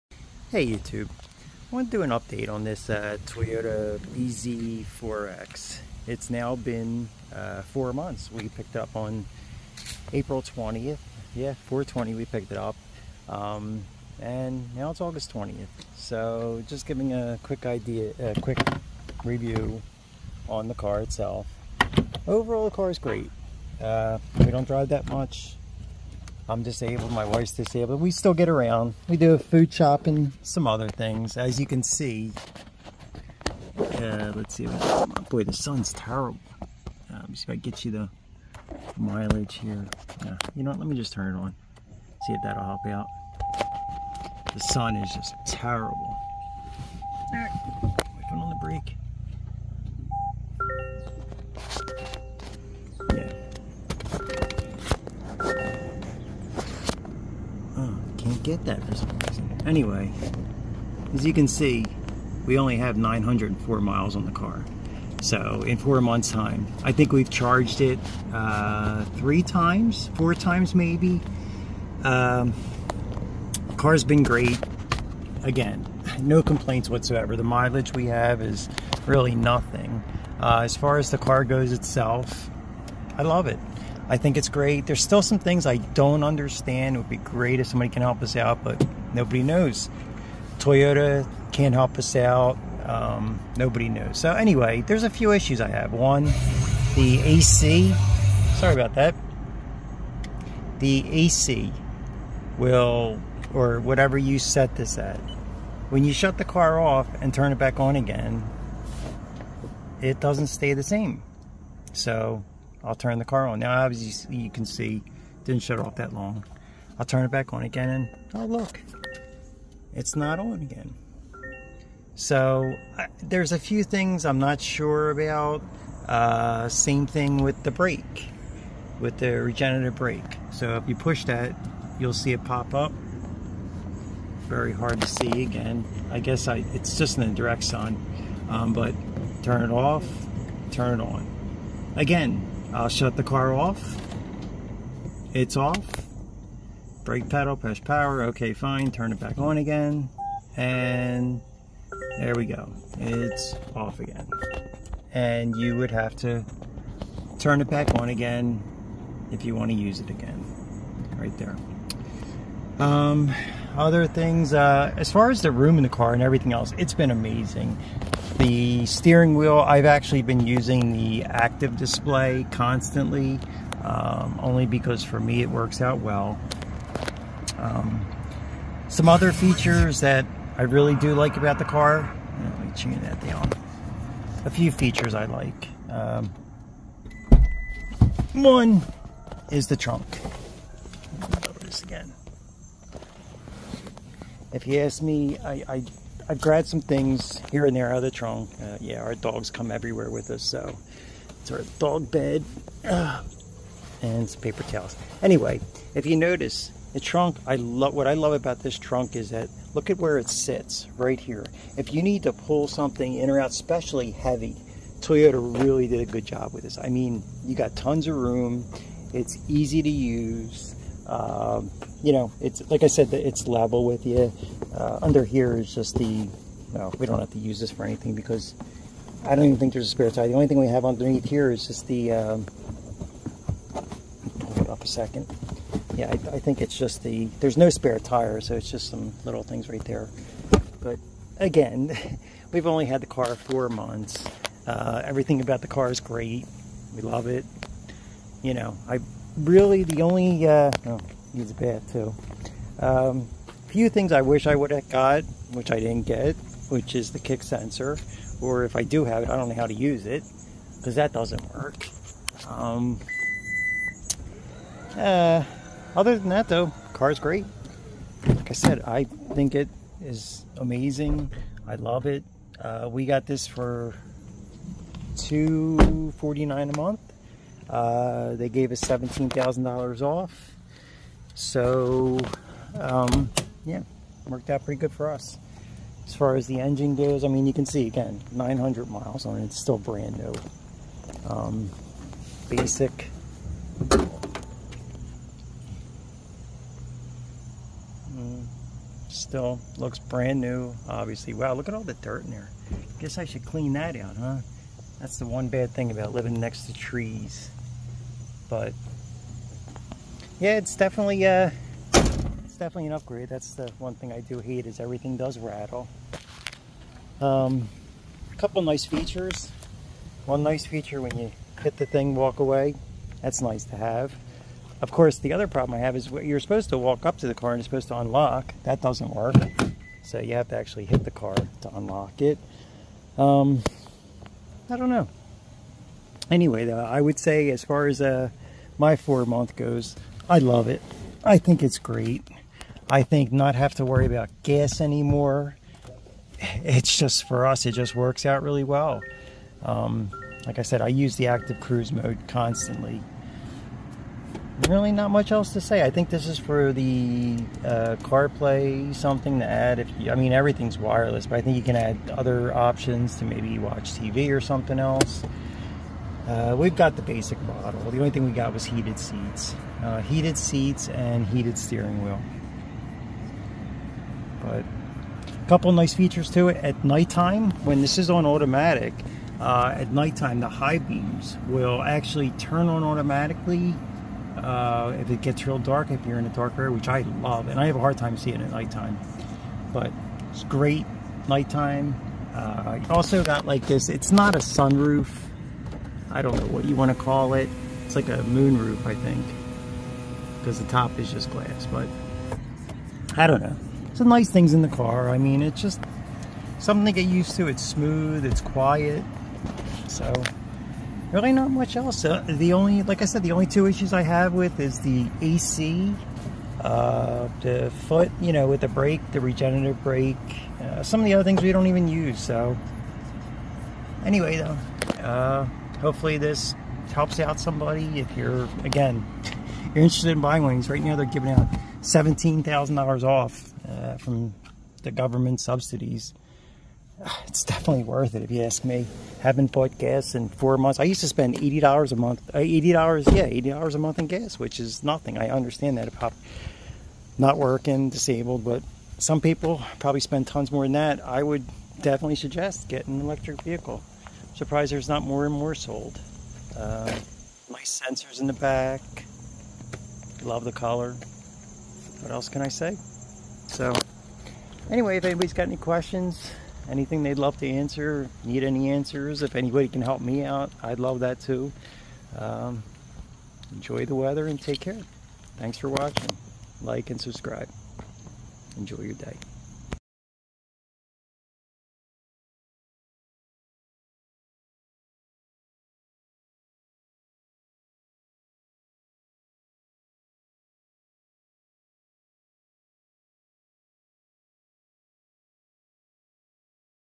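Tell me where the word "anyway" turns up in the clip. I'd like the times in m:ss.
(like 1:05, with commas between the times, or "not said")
0:59, 1:34, 3:25, 5:36, 7:04, 7:44.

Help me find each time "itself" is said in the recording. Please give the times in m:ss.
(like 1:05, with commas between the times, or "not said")
0:20, 1:21.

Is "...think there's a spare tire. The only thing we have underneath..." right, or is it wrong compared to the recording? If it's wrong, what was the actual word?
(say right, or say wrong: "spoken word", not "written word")
right.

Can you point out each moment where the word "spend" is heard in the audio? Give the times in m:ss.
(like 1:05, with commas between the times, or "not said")
7:21, 7:30.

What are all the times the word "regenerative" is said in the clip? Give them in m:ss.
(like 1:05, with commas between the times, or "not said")
2:09, 6:59.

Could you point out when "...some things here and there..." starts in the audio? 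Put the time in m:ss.
3:16.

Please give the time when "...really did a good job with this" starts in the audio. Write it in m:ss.
3:35.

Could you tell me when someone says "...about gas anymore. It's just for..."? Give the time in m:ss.
5:44.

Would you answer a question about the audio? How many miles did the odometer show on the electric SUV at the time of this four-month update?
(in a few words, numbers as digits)
904.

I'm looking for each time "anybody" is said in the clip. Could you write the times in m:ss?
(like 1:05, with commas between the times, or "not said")
7:45, 7:49.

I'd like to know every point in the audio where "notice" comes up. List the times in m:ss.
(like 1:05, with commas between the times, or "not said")
3:26.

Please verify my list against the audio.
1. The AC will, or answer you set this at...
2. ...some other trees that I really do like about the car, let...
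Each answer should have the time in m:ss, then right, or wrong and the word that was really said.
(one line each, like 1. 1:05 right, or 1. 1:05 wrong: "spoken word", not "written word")
1. 1:40 wrong: "whatever", not "answer"
2. 2:58 wrong: "features", not "trees".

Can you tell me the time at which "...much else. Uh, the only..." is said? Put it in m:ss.
6:51.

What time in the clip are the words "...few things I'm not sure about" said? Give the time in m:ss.
2:03.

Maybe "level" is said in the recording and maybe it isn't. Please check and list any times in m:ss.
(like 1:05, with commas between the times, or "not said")
3:43.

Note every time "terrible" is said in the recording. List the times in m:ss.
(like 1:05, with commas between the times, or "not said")
0:35, 0:45.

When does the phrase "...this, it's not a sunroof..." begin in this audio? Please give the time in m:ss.
6:33.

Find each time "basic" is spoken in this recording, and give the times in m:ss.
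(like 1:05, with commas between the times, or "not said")
4:52, 6:07.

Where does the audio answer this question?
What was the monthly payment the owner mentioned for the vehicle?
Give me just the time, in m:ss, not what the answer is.
4:35.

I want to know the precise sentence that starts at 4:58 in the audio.
Mm, still looks brand new, obviously.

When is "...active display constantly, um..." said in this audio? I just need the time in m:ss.
2:51.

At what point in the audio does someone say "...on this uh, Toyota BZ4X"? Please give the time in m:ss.
0:02.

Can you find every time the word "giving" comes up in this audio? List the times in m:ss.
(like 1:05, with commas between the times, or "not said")
0:16, 7:11.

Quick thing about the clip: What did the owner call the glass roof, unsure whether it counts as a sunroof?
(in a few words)
moonroof.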